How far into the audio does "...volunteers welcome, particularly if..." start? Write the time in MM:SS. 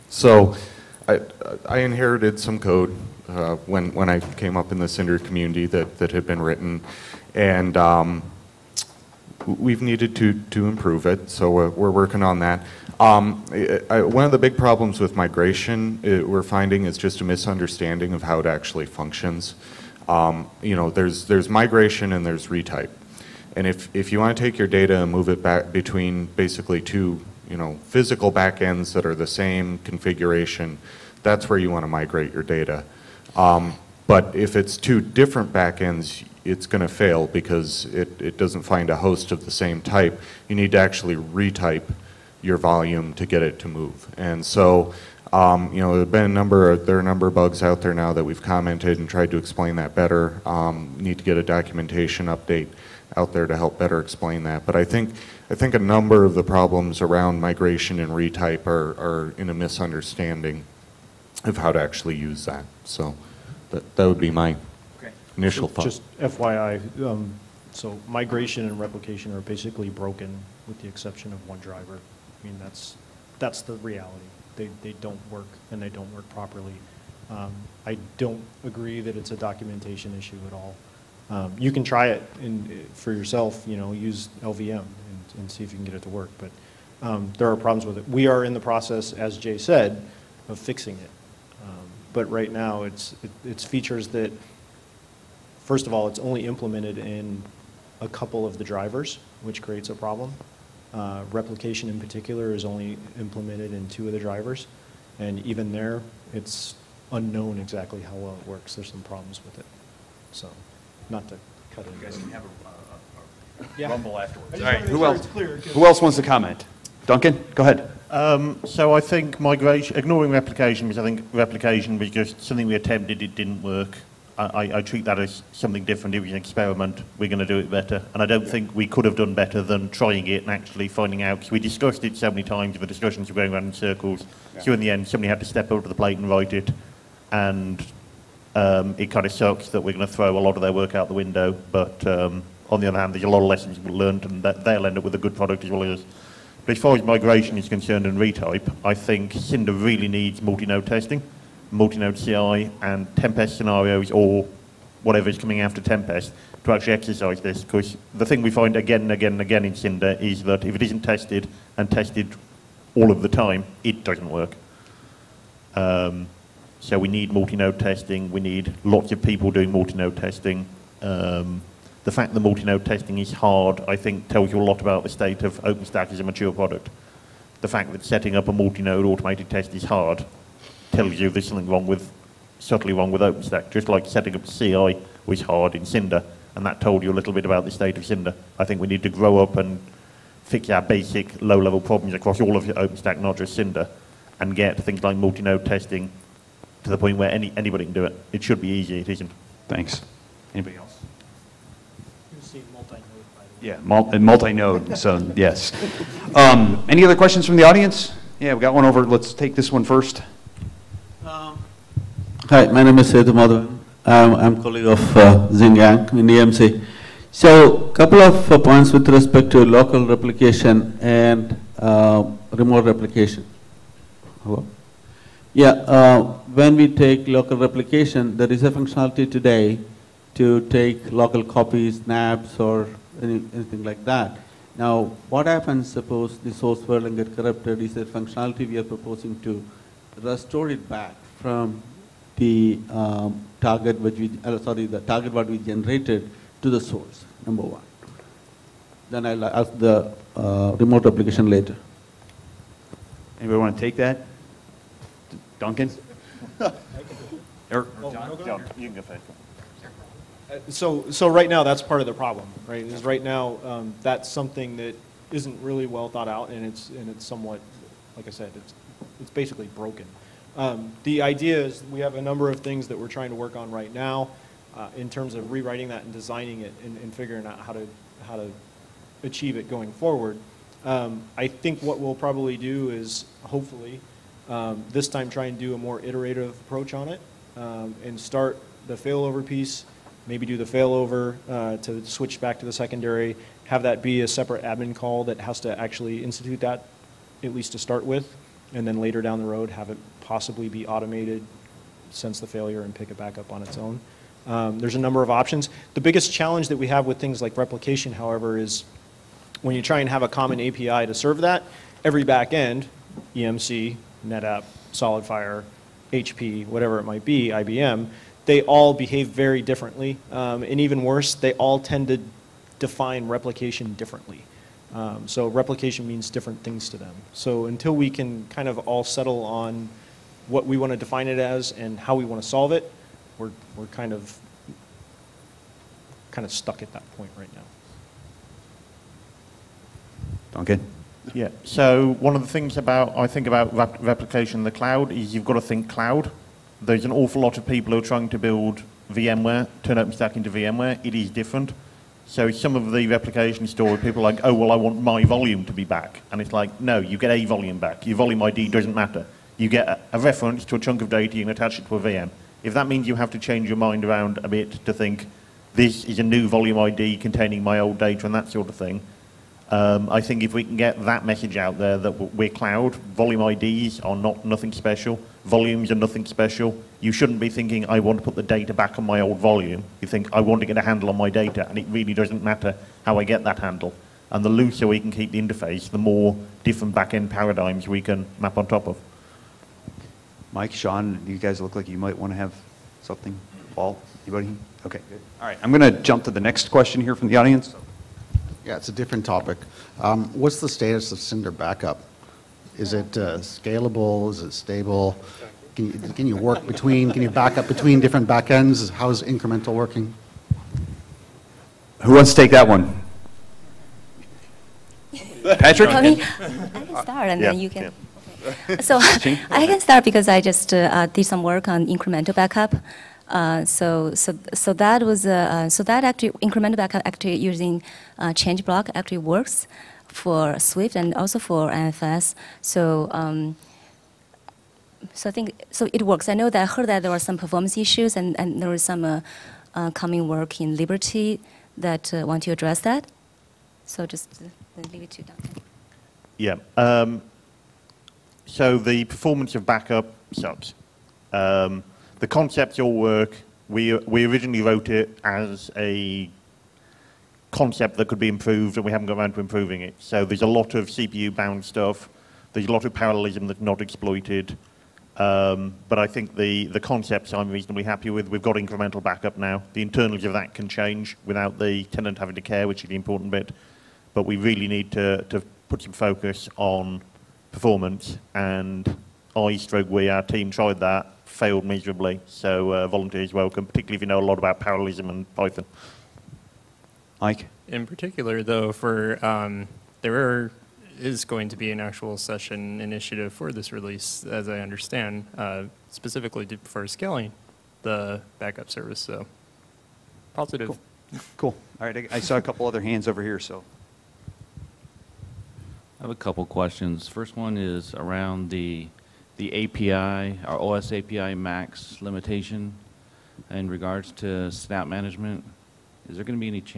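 08:02.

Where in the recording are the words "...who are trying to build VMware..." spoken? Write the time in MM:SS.
05:47.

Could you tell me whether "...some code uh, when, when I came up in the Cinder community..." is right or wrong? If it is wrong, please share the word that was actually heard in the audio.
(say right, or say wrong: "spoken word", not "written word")
right.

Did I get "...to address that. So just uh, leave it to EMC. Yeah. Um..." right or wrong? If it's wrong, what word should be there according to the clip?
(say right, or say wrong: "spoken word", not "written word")
wrong: "Doctor", not "EMC".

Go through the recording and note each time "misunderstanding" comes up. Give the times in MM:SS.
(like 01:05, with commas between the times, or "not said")
00:17, 00:59.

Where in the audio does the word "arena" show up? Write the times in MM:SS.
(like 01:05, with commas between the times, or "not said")
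not said.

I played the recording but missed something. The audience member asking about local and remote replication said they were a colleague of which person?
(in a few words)
Xing Yang.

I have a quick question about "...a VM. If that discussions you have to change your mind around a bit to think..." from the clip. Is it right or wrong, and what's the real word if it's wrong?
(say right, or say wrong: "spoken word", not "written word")
wrong: "means", not "discussions".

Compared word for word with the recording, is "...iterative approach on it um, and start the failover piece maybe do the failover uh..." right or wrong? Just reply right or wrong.
right.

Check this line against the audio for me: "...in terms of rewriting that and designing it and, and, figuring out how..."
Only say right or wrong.
right.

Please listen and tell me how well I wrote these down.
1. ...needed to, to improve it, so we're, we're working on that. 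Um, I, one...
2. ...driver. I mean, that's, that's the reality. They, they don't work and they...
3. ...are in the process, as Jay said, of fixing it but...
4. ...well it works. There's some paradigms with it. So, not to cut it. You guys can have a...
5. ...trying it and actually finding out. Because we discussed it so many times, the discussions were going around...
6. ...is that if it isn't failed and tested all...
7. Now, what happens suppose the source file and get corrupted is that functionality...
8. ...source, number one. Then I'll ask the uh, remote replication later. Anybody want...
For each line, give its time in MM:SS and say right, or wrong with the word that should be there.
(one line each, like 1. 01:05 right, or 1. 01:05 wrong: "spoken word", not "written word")
1. 00:09 right
2. 01:11 right
3. 01:28 right
4. 01:48 wrong: "problems", not "paradigms"
5. 02:09 right
6. 02:40 wrong: "tested", not "failed"
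7. 03:54 right
8. 04:06 right.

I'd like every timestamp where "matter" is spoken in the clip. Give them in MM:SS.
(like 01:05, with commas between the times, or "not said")
05:58, 06:22.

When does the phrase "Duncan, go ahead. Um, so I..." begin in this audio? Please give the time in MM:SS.
01:57.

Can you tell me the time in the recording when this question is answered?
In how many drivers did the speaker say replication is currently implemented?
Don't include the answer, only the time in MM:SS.
01:42.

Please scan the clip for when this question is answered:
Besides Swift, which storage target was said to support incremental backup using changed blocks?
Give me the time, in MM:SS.
07:11.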